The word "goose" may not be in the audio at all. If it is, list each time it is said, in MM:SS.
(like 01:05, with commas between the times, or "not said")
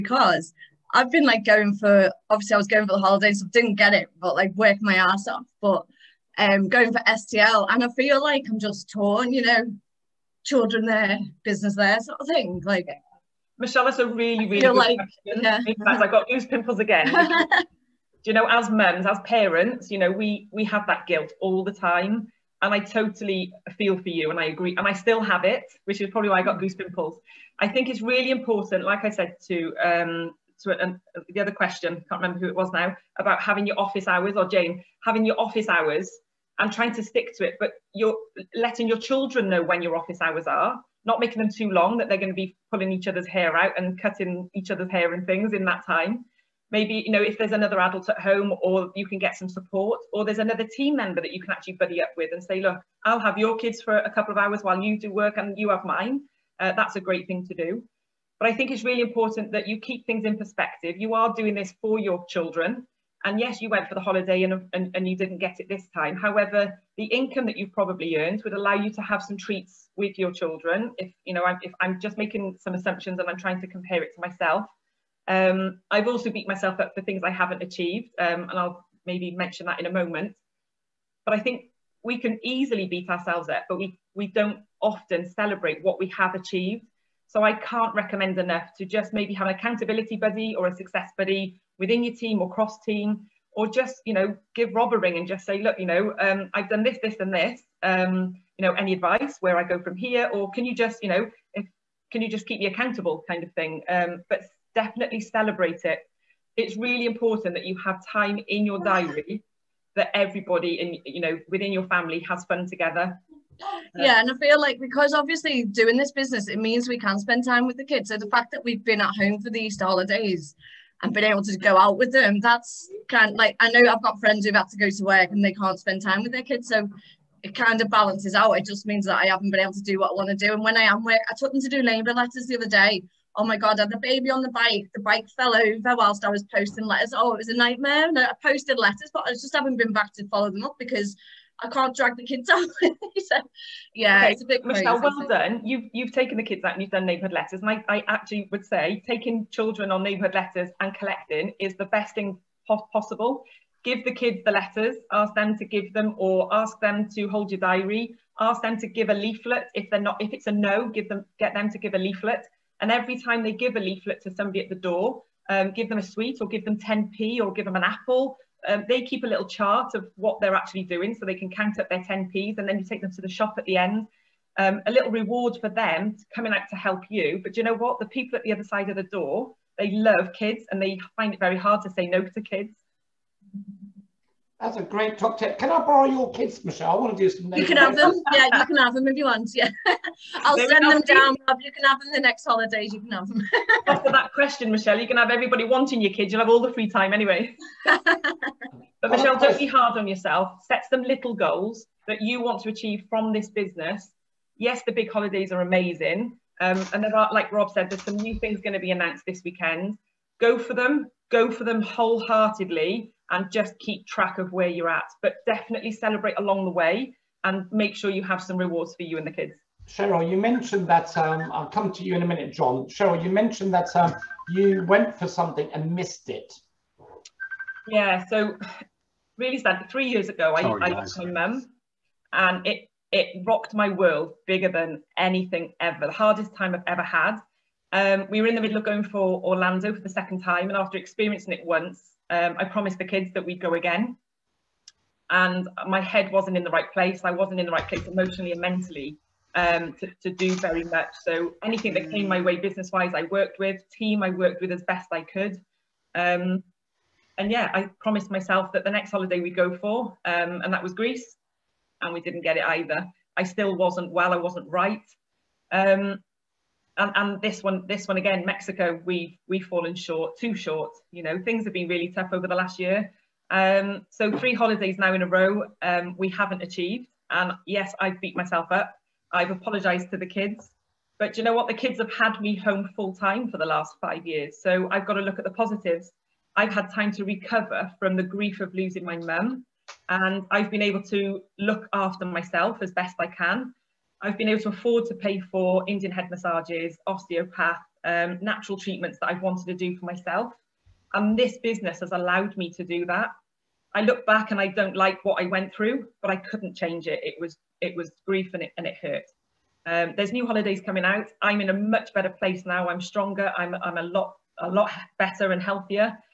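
00:16, 00:26.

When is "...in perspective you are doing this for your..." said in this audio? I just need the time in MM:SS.
01:00.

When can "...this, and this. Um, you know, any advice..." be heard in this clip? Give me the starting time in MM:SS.
01:37.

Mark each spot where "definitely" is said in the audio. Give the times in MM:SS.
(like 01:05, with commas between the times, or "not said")
01:44, 03:35.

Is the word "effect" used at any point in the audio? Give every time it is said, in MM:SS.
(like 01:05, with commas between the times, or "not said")
not said.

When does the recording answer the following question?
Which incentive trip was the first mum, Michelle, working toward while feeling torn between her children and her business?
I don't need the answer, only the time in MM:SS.
00:07.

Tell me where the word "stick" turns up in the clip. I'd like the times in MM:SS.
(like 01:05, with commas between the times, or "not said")
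00:37.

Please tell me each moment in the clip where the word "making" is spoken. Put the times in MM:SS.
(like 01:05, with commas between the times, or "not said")
00:41, 01:12.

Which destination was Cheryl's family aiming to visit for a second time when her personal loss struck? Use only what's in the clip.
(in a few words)
Orlando.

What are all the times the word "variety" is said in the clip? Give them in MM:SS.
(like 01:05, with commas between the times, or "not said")
not said.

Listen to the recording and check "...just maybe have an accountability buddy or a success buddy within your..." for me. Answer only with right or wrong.
right.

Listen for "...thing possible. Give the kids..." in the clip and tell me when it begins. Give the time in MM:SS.
02:32.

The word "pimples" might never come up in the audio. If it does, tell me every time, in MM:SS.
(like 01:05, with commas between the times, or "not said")
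00:16, 00:26.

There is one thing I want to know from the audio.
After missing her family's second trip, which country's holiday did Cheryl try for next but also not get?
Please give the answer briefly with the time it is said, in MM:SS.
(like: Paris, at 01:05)
Greece, at 04:20.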